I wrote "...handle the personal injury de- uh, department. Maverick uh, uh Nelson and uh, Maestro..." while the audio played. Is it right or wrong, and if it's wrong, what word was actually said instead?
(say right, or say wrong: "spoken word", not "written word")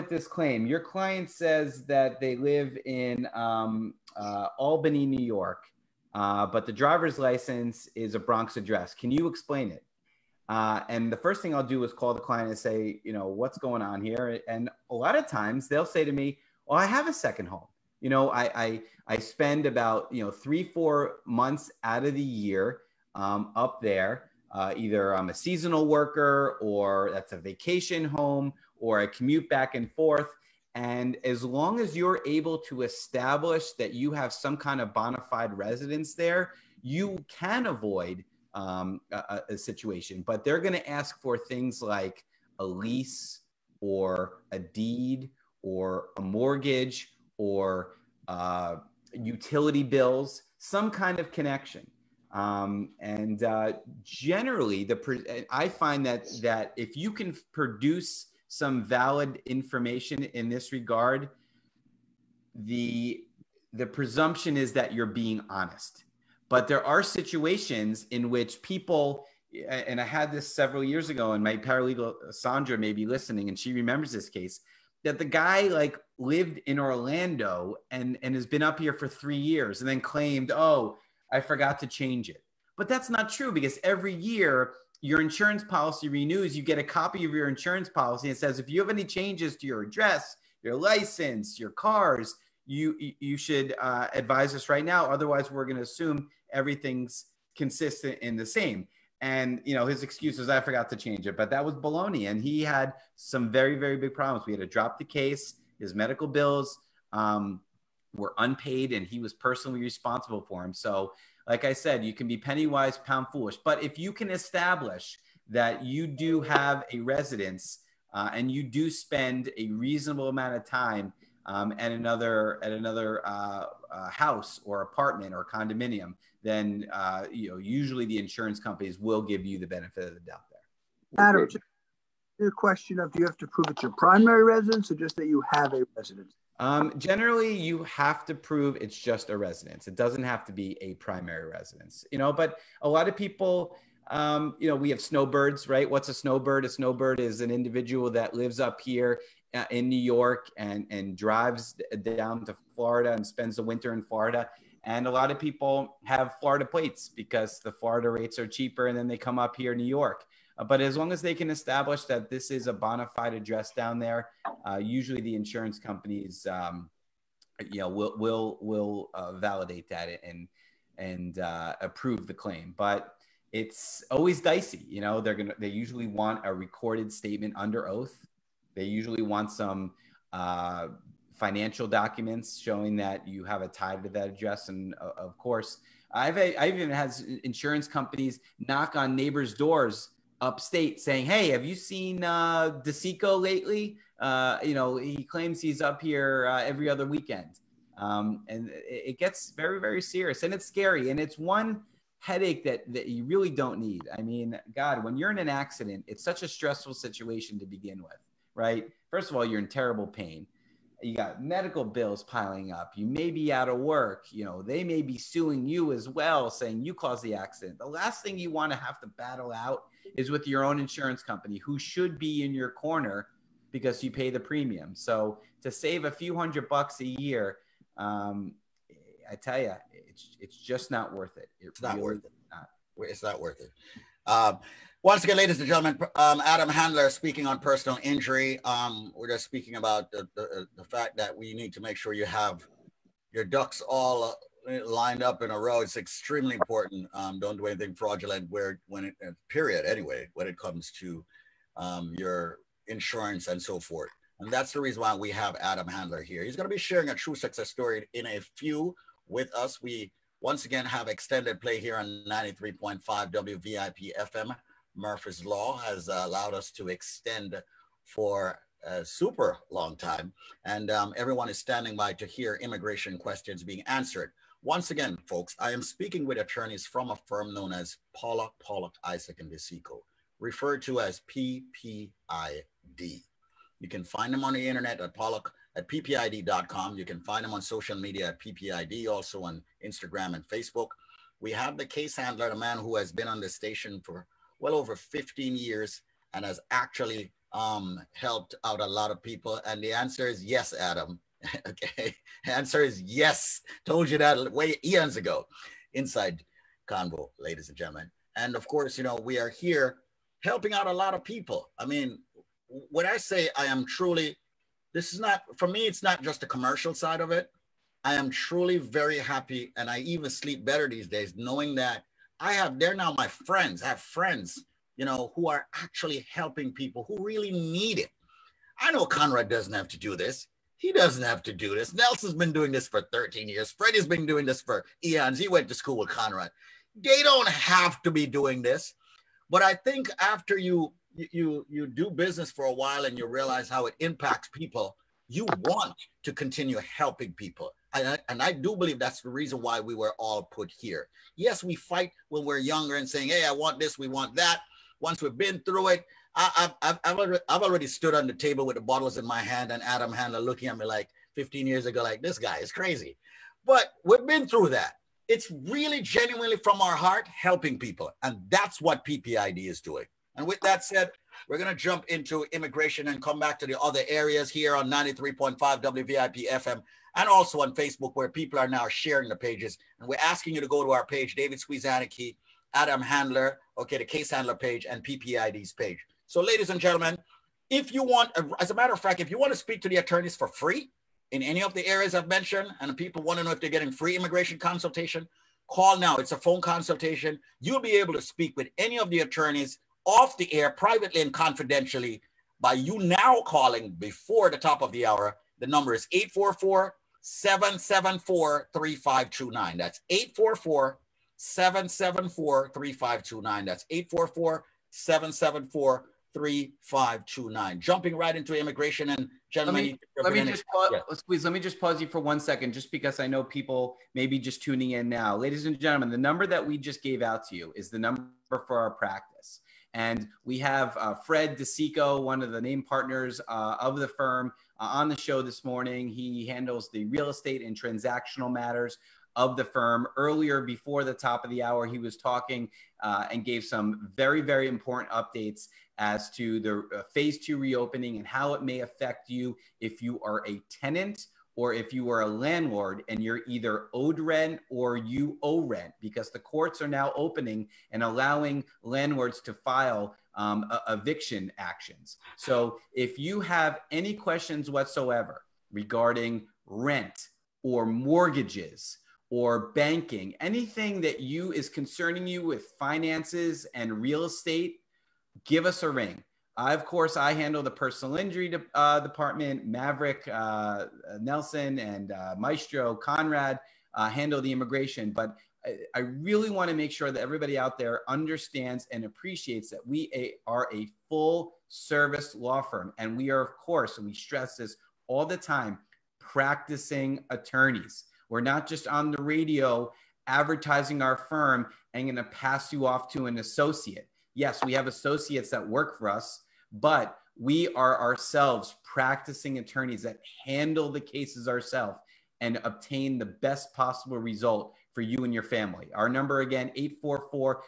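right.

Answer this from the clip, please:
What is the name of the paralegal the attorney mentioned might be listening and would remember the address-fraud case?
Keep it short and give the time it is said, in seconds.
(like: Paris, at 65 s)
Sandra, at 72 s.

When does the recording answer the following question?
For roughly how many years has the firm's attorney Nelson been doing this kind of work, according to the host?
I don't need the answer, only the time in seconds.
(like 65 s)
333 s.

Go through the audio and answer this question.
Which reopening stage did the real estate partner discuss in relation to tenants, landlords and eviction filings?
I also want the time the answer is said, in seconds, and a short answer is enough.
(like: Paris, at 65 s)
phase two, at 447 s.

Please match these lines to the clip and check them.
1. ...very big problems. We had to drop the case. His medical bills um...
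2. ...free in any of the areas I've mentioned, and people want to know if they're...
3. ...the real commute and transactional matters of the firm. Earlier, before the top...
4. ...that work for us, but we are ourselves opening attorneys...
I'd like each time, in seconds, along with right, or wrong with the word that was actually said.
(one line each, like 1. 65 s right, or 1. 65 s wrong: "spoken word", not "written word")
1. 103 s right
2. 390 s right
3. 436 s wrong: "estate", not "commute"
4. 505 s wrong: "practicing", not "opening".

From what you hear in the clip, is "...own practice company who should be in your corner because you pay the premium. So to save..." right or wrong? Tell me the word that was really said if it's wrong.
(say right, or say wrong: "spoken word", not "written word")
wrong: "insurance", not "practice".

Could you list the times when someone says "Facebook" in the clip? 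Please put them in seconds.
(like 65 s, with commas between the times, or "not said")
290 s, 377 s.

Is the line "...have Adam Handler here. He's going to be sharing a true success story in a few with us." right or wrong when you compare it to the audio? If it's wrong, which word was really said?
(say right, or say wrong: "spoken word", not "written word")
right.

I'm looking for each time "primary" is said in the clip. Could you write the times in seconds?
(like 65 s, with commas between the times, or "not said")
133 s, 140 s.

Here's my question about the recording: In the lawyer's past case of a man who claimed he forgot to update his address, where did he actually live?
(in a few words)
Orlando.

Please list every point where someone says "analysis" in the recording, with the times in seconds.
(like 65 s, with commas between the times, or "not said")
not said.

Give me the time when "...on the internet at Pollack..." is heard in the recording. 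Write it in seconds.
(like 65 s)
284 s.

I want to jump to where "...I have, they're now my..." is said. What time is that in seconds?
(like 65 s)
322 s.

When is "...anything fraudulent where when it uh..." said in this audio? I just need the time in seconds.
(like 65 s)
247 s.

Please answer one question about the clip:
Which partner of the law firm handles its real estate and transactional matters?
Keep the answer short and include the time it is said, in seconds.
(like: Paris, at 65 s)
Fred DeCicco, at 431 s.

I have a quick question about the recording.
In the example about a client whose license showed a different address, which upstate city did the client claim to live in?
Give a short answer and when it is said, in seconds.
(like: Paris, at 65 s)
Albany, at 4 s.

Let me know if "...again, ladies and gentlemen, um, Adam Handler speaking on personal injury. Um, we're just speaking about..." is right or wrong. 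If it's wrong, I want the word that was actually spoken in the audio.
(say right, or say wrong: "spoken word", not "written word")
right.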